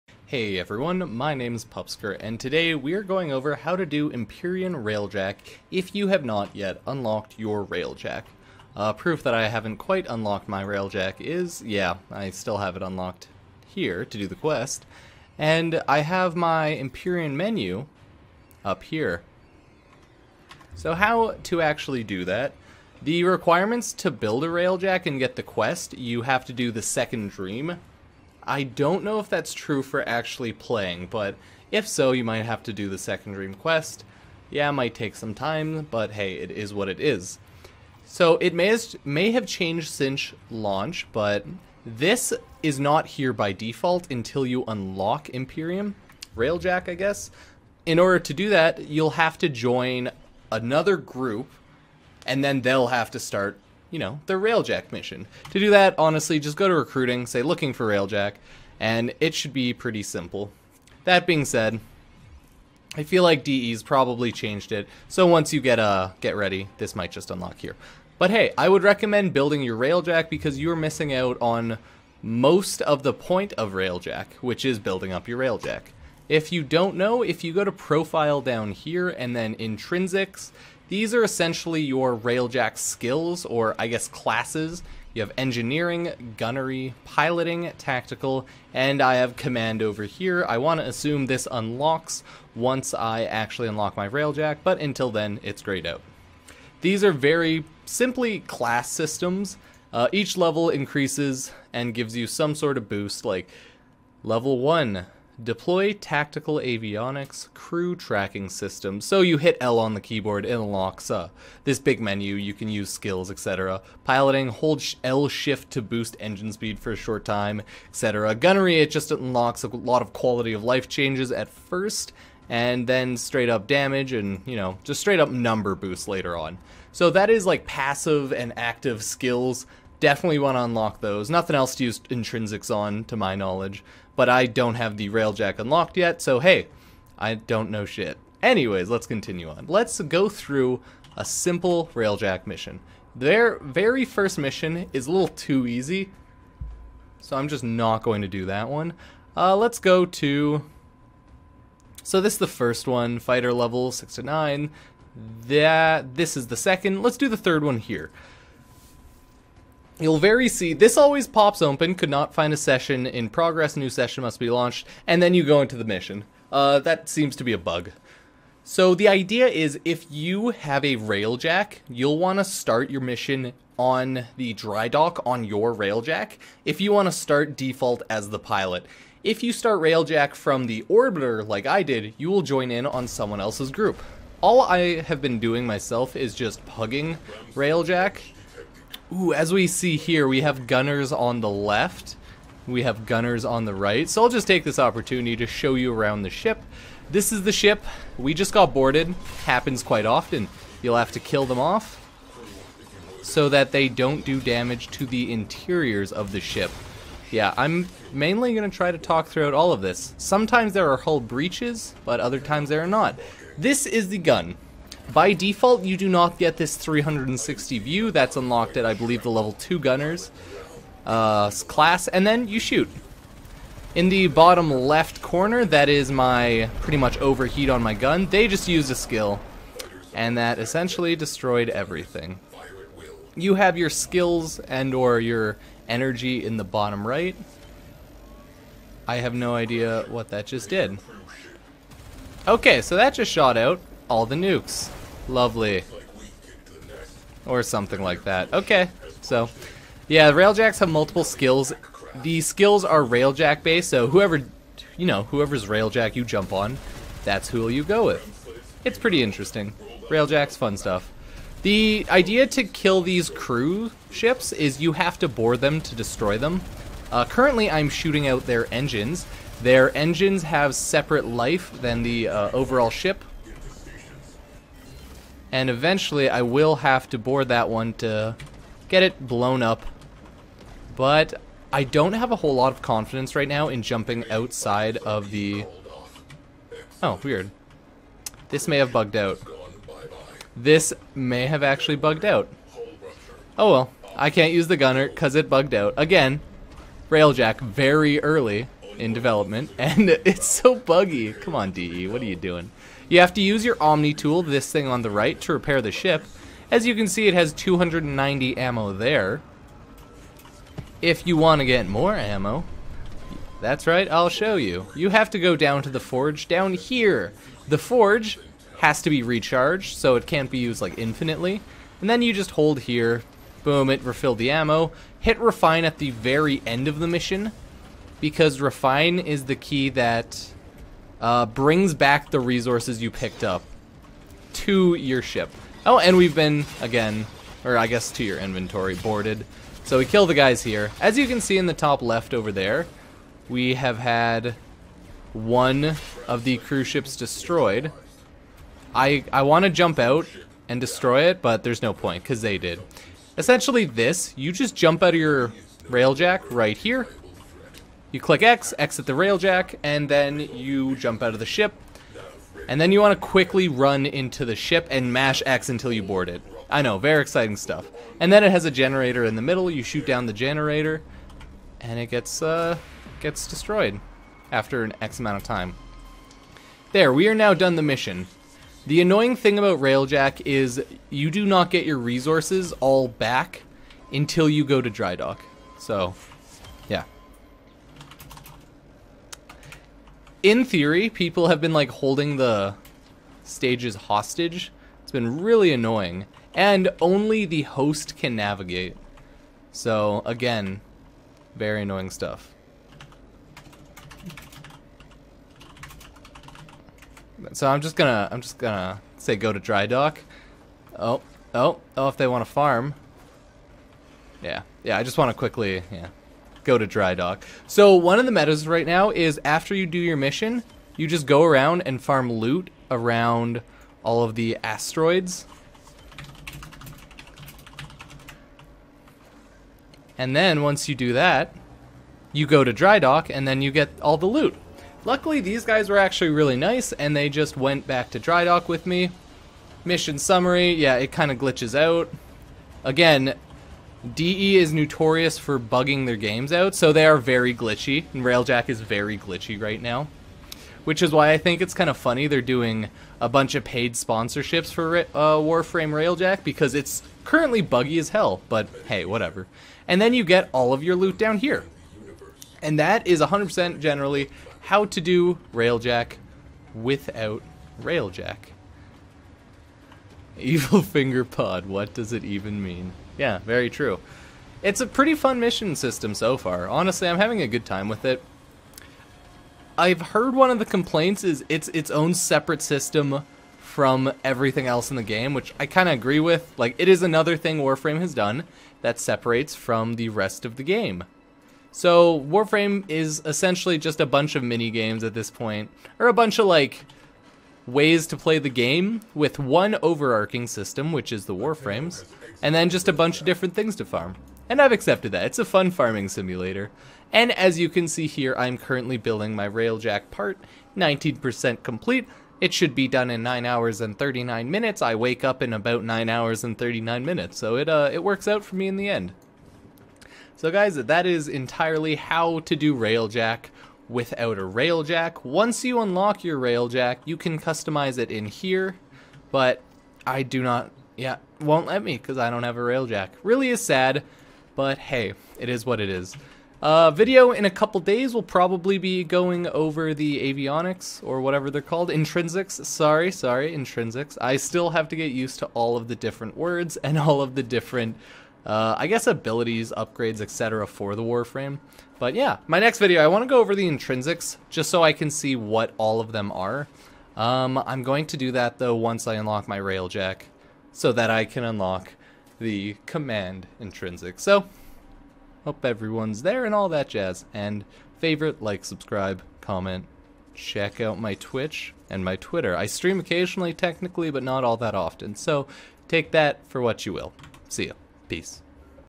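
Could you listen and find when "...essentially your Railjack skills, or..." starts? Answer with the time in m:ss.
1:21.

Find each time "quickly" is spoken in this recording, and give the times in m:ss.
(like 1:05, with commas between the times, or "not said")
6:03, 6:55.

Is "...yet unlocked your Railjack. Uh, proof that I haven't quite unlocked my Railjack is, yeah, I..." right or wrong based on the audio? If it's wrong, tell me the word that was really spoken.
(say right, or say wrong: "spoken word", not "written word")
right.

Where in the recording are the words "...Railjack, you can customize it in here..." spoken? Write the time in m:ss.
8:46.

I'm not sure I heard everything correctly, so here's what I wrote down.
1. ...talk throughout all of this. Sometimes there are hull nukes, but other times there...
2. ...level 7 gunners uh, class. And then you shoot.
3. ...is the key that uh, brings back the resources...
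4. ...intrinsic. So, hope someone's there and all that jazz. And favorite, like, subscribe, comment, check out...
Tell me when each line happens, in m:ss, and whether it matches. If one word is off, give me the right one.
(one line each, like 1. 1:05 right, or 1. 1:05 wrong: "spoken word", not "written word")
1. 3:28 wrong: "breaches", not "nukes"
2. 3:39 wrong: "2", not "7"
3. 5:29 right
4. 9:23 wrong: "everyone", not "someone".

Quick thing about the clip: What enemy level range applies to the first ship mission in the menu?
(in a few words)
6 to 9.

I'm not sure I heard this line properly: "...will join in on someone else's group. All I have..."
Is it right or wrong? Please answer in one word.
right.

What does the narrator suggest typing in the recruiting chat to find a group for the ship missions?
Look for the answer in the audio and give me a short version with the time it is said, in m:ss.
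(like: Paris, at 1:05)
Looking for Railjack, at 0:57.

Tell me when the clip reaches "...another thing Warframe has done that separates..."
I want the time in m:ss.
8:07.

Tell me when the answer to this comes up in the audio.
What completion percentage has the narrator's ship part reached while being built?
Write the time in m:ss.
8:30.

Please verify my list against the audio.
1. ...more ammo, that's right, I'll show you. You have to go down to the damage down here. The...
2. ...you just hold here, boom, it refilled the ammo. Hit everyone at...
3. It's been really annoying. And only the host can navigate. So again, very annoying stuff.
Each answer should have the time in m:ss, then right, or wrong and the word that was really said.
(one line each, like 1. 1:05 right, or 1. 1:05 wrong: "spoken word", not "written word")
1. 5:11 wrong: "forge", not "damage"
2. 5:22 wrong: "refine", not "everyone"
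3. 6:35 right.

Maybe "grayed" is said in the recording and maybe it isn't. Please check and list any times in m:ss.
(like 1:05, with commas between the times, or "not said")
1:35.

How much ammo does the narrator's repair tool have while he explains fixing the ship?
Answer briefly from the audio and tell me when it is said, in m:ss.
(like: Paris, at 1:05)
290, at 5:07.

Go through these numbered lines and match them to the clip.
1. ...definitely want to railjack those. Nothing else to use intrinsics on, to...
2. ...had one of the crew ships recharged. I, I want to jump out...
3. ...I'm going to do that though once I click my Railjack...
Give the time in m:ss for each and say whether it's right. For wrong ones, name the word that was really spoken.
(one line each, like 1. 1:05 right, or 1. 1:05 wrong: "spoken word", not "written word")
1. 2:10 wrong: "unlock", not "railjack"
2. 5:43 wrong: "destroyed", not "recharged"
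3. 9:17 wrong: "unlock", not "click".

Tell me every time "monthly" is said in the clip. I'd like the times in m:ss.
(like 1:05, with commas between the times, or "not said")
not said.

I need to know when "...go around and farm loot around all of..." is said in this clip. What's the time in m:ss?
7:01.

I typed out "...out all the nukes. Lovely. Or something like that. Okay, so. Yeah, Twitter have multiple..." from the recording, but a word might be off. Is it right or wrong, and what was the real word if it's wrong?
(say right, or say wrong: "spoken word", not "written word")
wrong: "Railjacks", not "Twitter".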